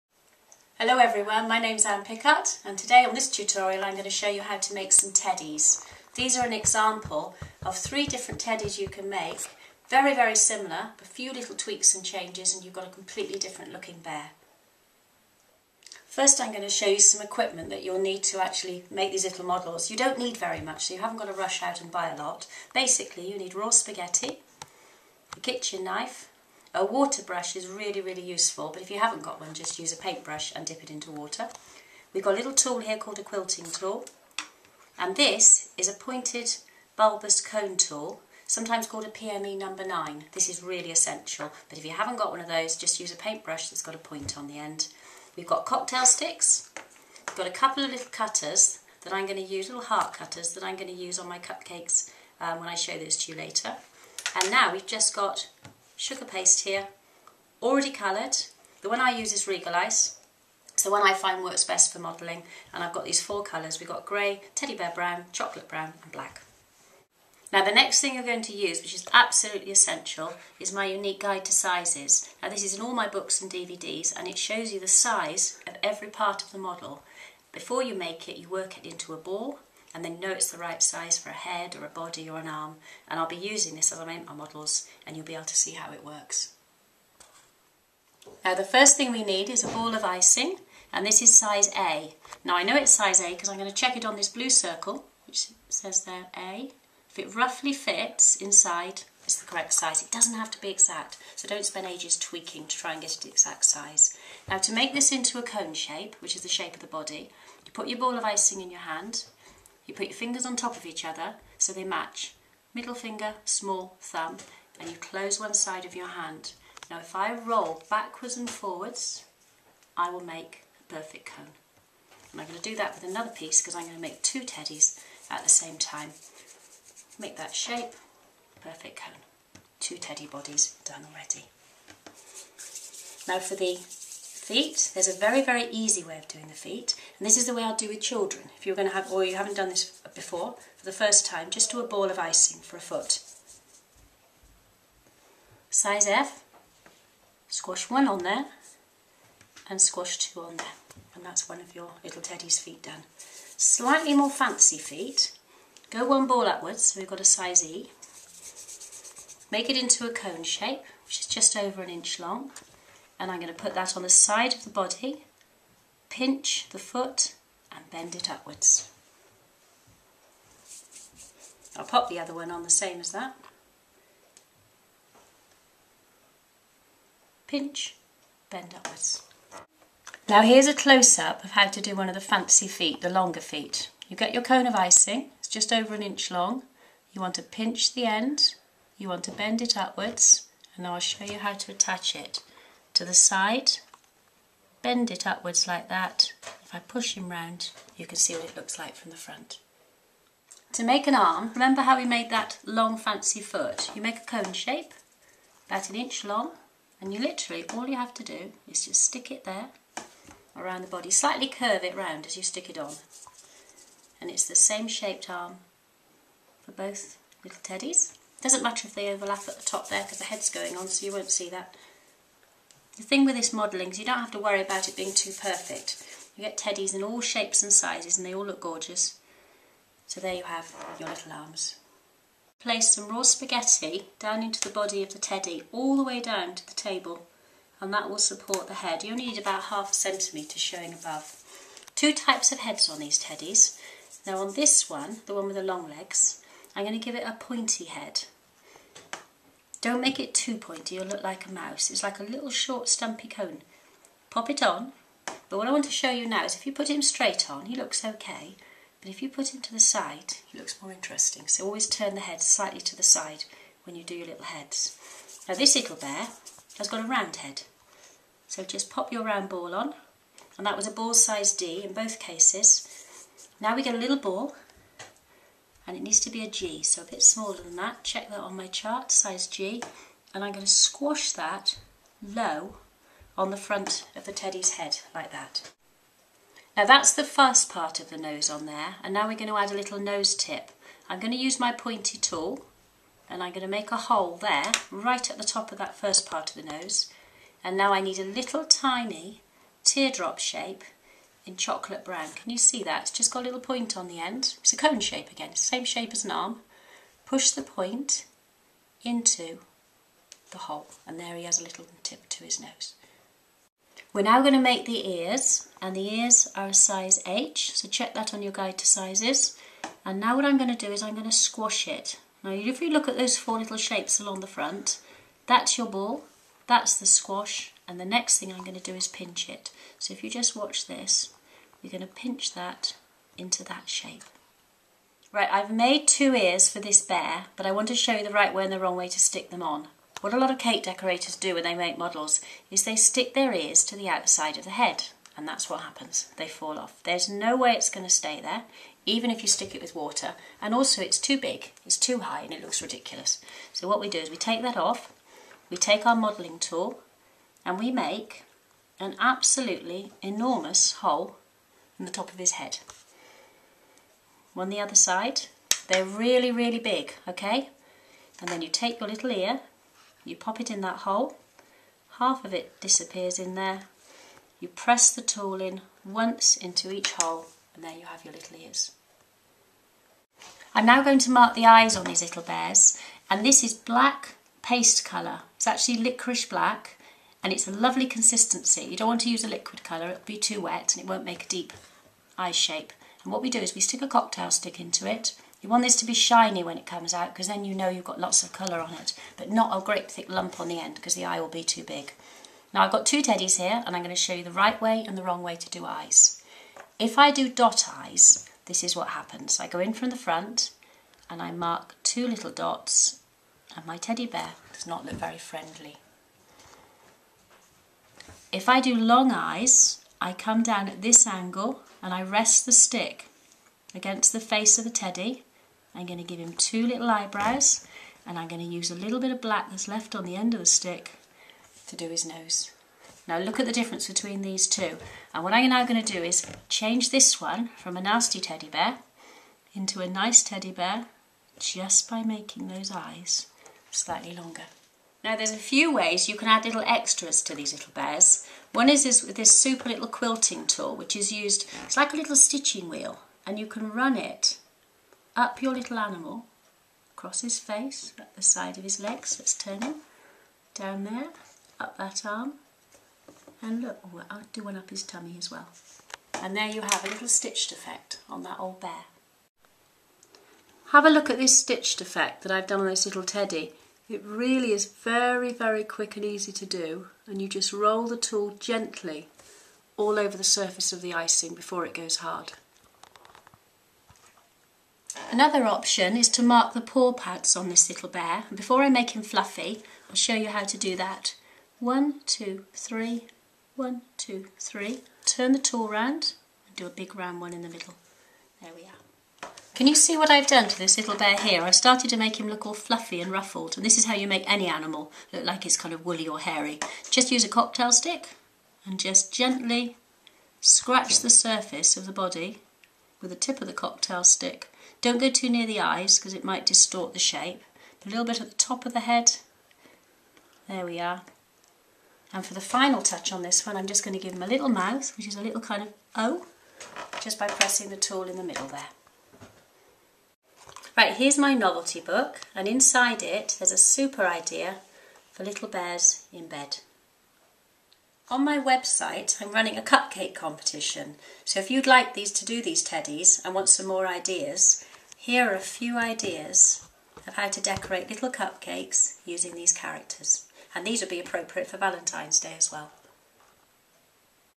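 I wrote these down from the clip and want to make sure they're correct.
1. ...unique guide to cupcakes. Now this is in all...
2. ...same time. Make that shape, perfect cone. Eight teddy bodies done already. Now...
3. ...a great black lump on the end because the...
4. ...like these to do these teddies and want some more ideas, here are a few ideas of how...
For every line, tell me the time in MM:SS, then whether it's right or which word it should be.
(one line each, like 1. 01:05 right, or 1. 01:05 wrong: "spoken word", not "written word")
1. 01:10 wrong: "sizes", not "cupcakes"
2. 02:05 wrong: "Two", not "Eight"
3. 06:39 wrong: "thick", not "black"
4. 09:01 right.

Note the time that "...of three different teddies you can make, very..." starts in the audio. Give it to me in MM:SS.
00:07.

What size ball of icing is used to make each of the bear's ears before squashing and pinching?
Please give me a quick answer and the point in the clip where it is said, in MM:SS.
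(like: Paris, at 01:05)
Size H, at 05:16.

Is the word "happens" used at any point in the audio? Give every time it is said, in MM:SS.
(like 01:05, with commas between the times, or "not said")
05:45, 06:49.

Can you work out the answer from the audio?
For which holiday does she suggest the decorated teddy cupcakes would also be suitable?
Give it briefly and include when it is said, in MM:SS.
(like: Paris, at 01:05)
Valentine's Day, at 09:11.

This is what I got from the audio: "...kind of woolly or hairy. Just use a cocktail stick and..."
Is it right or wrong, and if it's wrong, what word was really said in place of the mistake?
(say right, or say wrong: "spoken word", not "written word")
right.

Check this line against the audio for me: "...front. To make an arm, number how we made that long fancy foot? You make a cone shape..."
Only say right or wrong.
wrong.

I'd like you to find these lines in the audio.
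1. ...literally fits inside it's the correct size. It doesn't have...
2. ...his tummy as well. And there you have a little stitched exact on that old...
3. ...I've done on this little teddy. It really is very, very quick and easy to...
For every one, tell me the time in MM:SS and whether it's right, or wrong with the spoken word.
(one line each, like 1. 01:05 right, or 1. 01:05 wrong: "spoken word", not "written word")
1. 01:37 wrong: "roughly", not "literally"
2. 07:44 wrong: "effect", not "exact"
3. 07:52 right.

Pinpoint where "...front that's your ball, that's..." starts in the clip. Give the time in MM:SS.
05:24.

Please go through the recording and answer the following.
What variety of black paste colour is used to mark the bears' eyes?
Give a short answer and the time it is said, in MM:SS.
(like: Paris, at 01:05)
Licorice black, at 06:25.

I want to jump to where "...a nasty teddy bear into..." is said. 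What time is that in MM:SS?
07:17.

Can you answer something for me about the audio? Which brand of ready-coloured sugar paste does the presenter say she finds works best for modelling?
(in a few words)
Regalice.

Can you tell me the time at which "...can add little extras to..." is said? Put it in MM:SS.
07:26.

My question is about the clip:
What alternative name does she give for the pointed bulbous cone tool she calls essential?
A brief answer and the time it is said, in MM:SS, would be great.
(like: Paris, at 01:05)
PME number 9, at 00:39.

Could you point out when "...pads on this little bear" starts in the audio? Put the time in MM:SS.
08:07.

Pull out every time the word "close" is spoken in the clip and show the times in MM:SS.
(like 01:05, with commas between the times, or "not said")
01:54, 03:00.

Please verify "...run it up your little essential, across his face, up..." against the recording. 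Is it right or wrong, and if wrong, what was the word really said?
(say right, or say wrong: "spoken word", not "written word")
wrong: "animal", not "essential".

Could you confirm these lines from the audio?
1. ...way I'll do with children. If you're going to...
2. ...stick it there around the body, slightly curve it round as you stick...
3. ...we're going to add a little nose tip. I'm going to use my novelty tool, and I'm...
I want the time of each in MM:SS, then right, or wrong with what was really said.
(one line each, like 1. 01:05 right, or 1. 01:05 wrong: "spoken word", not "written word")
1. 02:17 right
2. 03:29 right
3. 04:49 wrong: "pointy", not "novelty".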